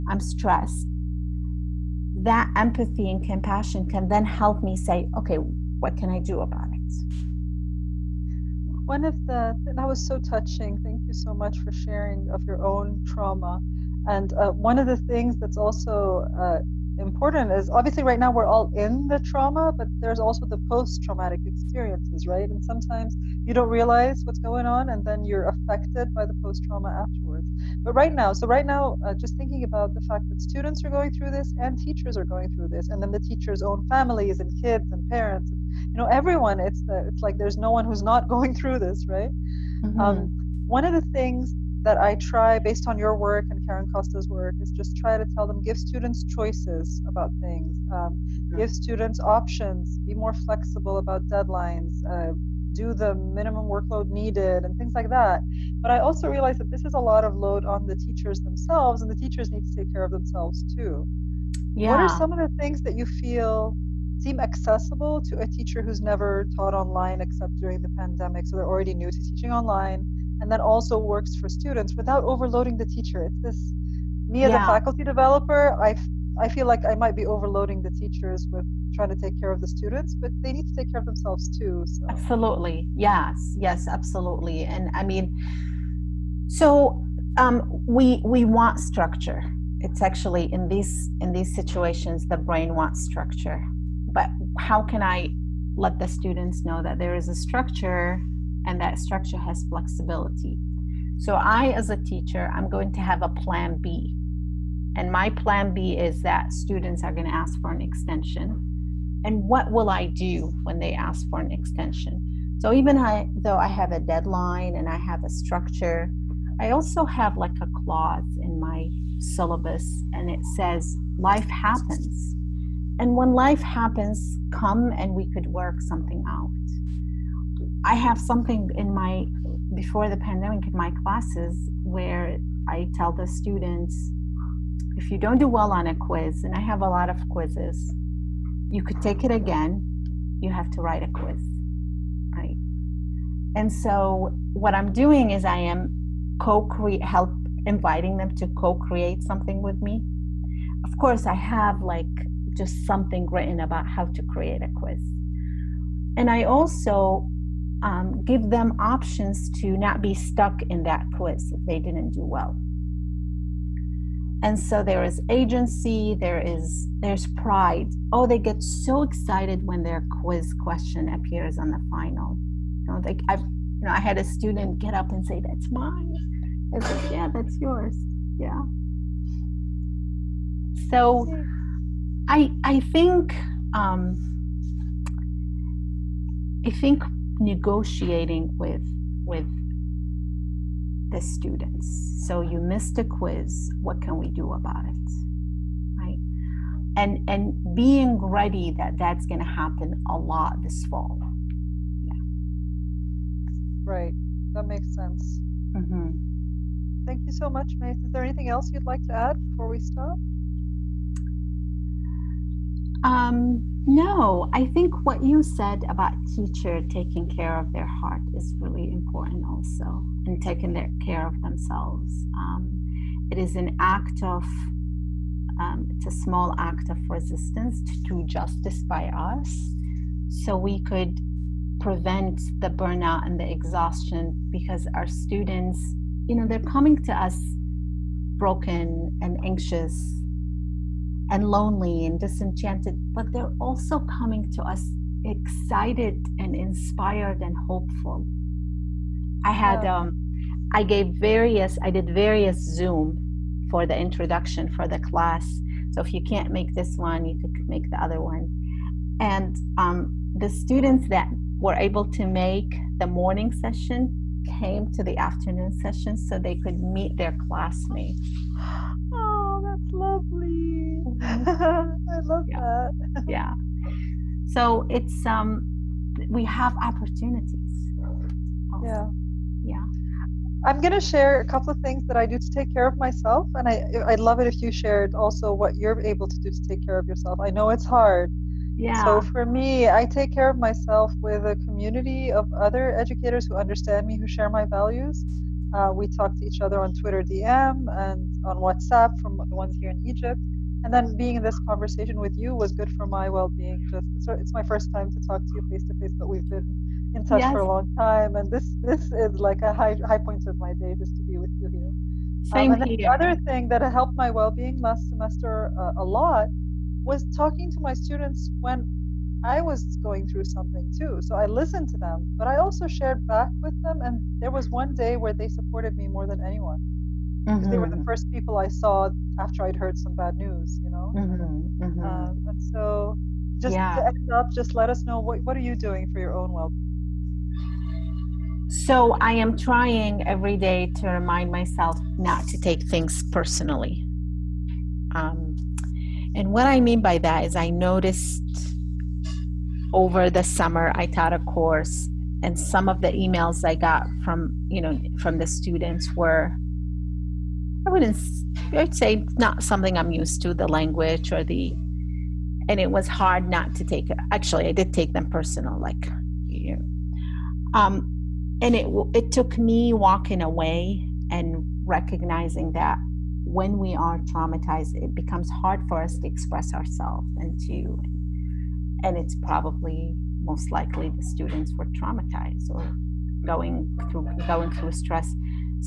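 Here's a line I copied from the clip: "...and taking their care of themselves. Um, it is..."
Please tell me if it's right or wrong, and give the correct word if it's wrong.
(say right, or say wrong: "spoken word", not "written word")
right.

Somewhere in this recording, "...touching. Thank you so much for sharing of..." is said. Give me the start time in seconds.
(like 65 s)
10 s.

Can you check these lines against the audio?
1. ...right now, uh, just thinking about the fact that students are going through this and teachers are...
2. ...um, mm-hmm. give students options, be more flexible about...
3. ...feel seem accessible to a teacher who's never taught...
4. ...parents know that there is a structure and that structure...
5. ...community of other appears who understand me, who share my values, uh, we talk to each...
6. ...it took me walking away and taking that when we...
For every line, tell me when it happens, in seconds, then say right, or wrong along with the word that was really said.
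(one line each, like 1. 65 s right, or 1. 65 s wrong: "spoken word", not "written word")
1. 28 s right
2. 47 s right
3. 63 s right
4. 96 s wrong: "students", not "parents"
5. 291 s wrong: "educators", not "appears"
6. 369 s wrong: "recognizing", not "taking".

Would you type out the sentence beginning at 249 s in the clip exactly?
um, I gave various, I did various Zoom for the introduction for the class.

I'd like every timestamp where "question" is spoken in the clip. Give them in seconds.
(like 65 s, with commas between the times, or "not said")
170 s.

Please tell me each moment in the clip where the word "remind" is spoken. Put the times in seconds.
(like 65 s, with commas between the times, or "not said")
341 s.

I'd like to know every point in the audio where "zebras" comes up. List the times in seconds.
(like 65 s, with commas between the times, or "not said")
not said.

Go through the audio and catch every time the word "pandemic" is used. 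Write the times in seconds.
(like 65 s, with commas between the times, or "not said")
67 s, 130 s.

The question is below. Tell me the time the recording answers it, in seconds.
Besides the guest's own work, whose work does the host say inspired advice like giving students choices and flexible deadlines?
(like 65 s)
43 s.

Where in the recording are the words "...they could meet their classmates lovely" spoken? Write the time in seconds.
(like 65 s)
266 s.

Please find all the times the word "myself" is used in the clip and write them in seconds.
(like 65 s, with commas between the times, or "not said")
282 s, 290 s, 341 s.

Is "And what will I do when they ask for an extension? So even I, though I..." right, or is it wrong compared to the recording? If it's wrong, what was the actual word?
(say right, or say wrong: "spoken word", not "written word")
right.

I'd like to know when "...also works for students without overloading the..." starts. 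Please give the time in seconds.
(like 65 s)
70 s.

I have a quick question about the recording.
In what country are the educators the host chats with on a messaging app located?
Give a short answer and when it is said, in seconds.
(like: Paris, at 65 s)
Egypt, at 300 s.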